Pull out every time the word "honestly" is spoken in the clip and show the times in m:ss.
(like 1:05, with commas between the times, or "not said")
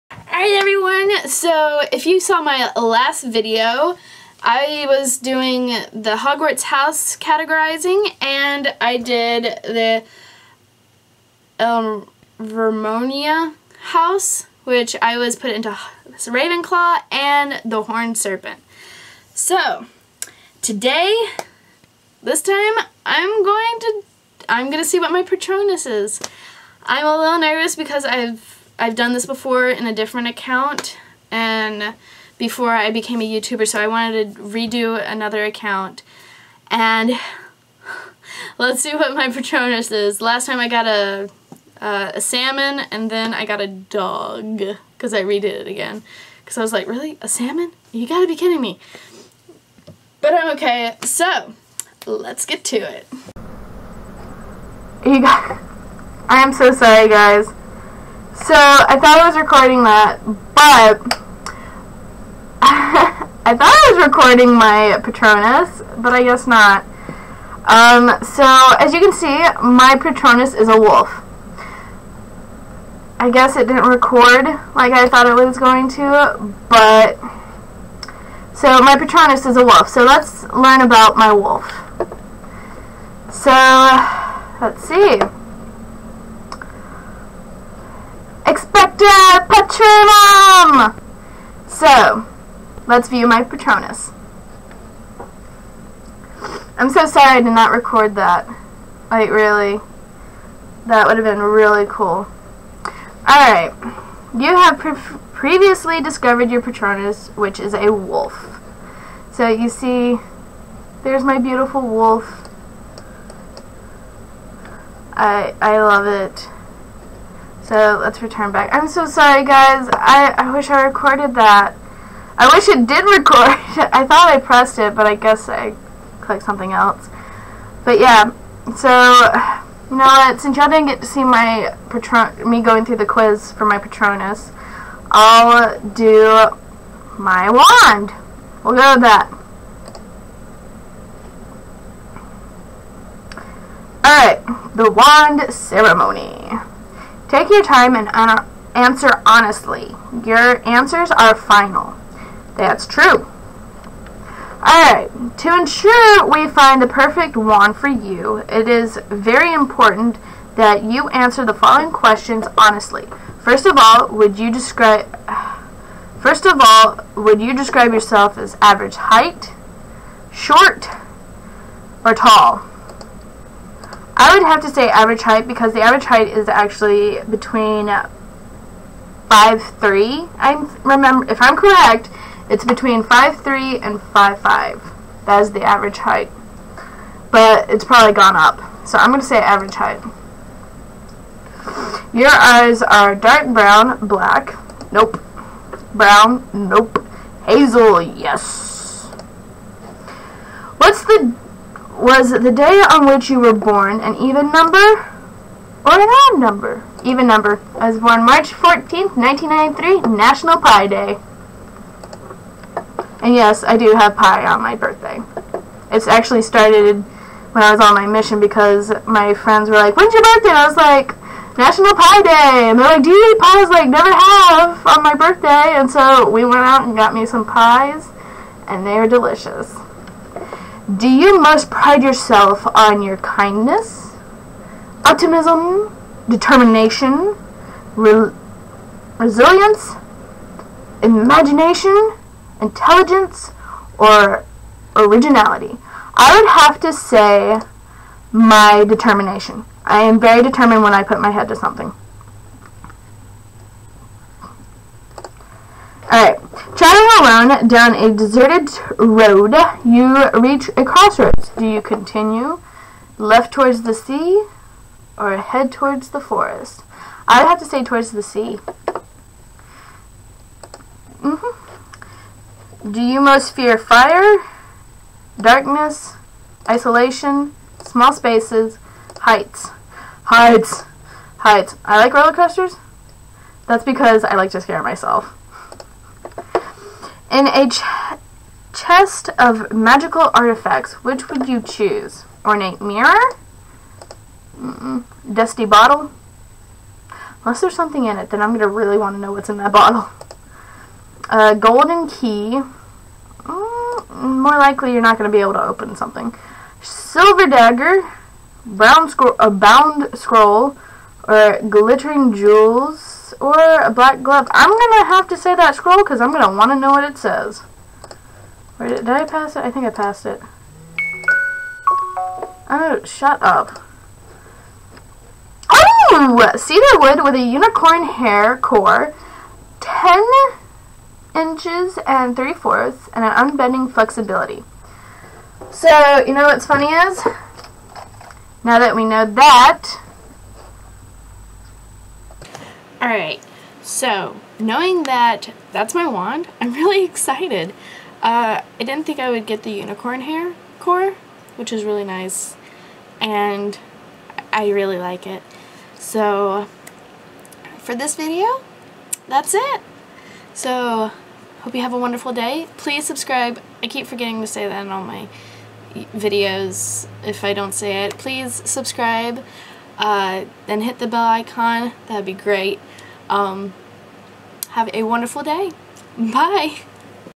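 2:29, 2:42.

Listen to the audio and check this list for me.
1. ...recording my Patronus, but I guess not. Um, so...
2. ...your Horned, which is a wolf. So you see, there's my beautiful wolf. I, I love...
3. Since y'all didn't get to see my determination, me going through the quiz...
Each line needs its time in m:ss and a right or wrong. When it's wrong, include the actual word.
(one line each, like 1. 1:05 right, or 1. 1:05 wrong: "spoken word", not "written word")
1. 1:04 right
2. 1:46 wrong: "Patronus", not "Horned"
3. 2:10 wrong: "patron", not "determination".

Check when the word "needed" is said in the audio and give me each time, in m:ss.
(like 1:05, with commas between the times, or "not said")
not said.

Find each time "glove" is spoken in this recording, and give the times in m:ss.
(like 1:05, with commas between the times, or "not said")
5:14.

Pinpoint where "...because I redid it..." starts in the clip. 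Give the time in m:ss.
0:44.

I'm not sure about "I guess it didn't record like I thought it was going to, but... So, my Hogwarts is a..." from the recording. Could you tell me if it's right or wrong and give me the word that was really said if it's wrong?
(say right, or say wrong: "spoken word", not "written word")
wrong: "Patronus", not "Hogwarts".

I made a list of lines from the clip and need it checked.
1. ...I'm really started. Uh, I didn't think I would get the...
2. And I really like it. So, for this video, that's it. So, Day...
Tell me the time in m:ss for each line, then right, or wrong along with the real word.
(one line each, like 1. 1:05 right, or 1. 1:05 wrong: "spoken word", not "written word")
1. 5:46 wrong: "excited", not "started"
2. 5:53 wrong: "Hope", not "Day".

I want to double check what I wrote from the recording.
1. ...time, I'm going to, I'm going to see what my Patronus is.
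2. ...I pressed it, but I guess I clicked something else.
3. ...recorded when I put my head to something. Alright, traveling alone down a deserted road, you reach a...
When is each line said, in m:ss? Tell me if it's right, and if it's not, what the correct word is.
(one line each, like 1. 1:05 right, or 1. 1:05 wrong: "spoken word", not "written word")
1. 0:22 right
2. 2:04 right
3. 4:10 wrong: "determined", not "recorded".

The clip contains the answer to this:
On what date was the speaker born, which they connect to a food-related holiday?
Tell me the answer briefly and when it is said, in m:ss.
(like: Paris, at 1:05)
March 14th, 1993, at 3:28.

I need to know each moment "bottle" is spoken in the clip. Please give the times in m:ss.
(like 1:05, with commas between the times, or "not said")
4:55, 4:59.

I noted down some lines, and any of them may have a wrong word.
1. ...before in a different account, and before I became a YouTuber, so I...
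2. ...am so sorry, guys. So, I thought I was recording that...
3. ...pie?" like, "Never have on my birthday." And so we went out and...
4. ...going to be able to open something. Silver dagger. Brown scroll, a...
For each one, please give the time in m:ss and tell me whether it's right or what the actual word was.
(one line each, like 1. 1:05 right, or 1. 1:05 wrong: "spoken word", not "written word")
1. 0:29 right
2. 0:56 right
3. 3:43 right
4. 5:05 right.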